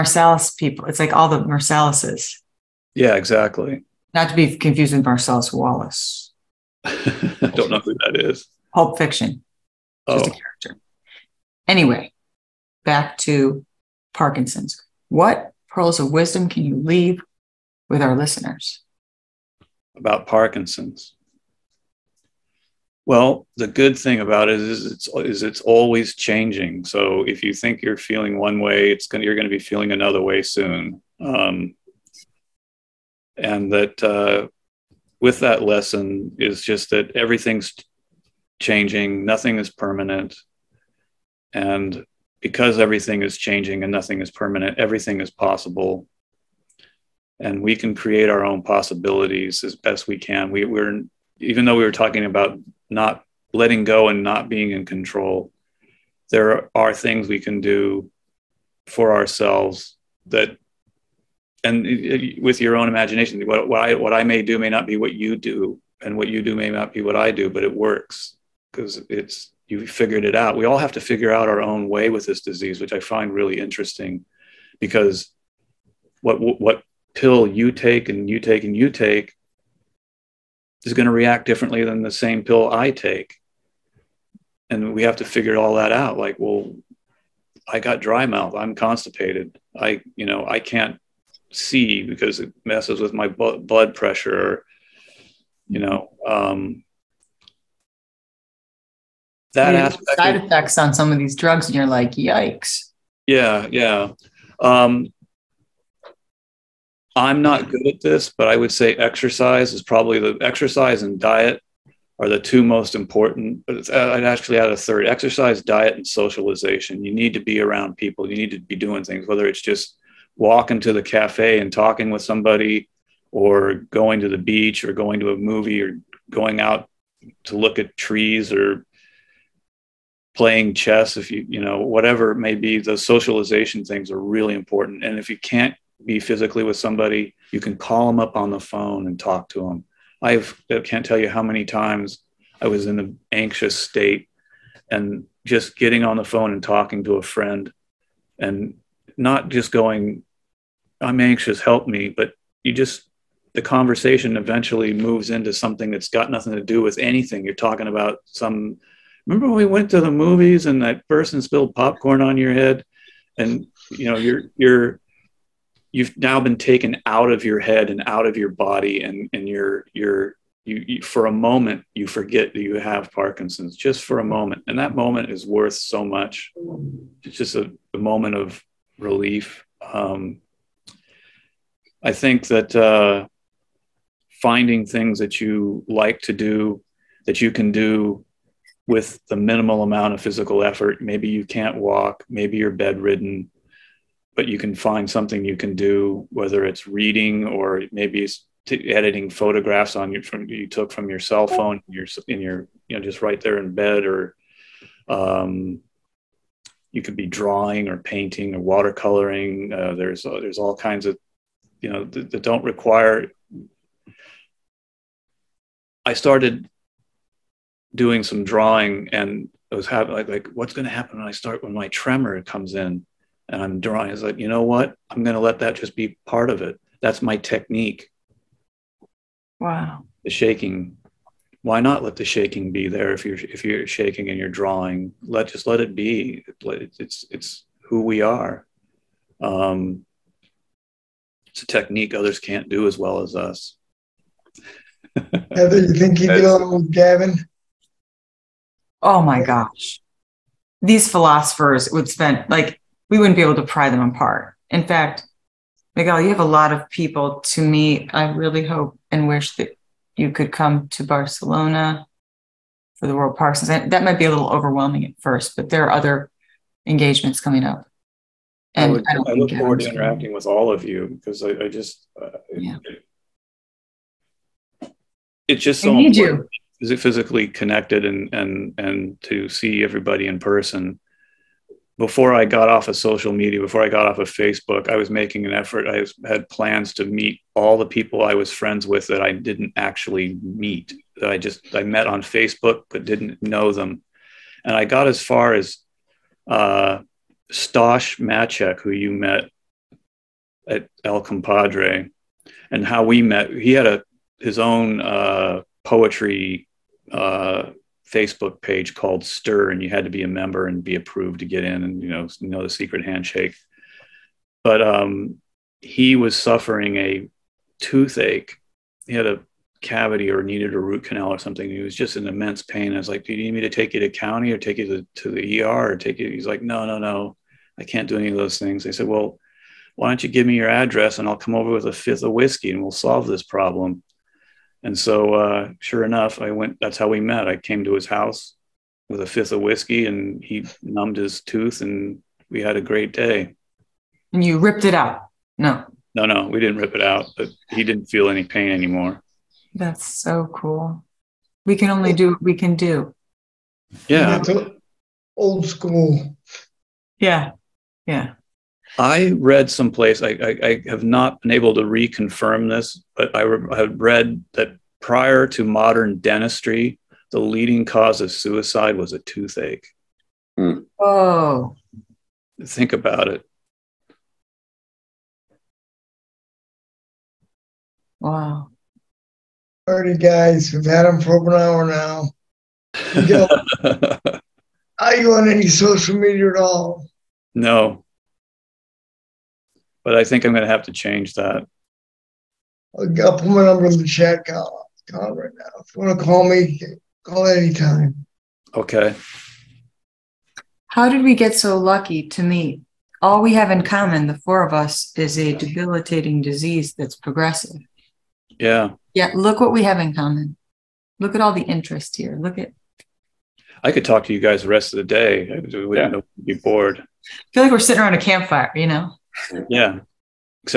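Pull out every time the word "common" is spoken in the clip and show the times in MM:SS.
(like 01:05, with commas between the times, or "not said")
06:43, 06:50.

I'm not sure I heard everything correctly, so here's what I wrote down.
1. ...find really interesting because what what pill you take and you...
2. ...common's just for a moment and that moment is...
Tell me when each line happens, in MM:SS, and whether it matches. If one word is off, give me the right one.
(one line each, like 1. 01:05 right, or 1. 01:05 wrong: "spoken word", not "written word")
1. 01:12 right
2. 02:53 wrong: "parkinson", not "common".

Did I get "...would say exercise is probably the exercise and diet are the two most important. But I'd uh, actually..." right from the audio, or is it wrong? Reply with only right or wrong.
right.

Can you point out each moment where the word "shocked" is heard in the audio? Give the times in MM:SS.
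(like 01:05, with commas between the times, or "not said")
not said.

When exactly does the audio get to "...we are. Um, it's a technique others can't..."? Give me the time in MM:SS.
03:58.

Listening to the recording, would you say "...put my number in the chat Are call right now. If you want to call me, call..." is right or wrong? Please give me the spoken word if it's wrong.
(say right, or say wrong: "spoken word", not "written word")
wrong: "Call", not "Are".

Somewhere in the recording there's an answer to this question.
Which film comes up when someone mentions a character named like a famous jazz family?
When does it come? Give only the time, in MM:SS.
00:08.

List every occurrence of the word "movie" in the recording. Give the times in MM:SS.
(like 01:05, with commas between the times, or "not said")
02:05, 02:40.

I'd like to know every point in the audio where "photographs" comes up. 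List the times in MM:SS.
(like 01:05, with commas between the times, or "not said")
03:19.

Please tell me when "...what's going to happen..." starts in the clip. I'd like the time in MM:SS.
03:40.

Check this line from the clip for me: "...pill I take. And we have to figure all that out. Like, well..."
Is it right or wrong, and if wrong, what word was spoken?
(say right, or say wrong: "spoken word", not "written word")
right.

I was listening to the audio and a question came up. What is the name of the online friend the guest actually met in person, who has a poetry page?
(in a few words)
Stosh Machek.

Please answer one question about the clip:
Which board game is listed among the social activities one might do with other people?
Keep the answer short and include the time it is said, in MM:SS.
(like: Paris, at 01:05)
Chess, at 02:10.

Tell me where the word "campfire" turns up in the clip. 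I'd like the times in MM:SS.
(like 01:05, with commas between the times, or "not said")
06:58.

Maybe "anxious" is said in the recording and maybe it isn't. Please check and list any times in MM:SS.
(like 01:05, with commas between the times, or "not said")
02:23, 02:31.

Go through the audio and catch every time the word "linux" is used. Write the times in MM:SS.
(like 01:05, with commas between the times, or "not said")
not said.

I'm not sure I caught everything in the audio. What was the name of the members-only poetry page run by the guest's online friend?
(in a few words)
Stir.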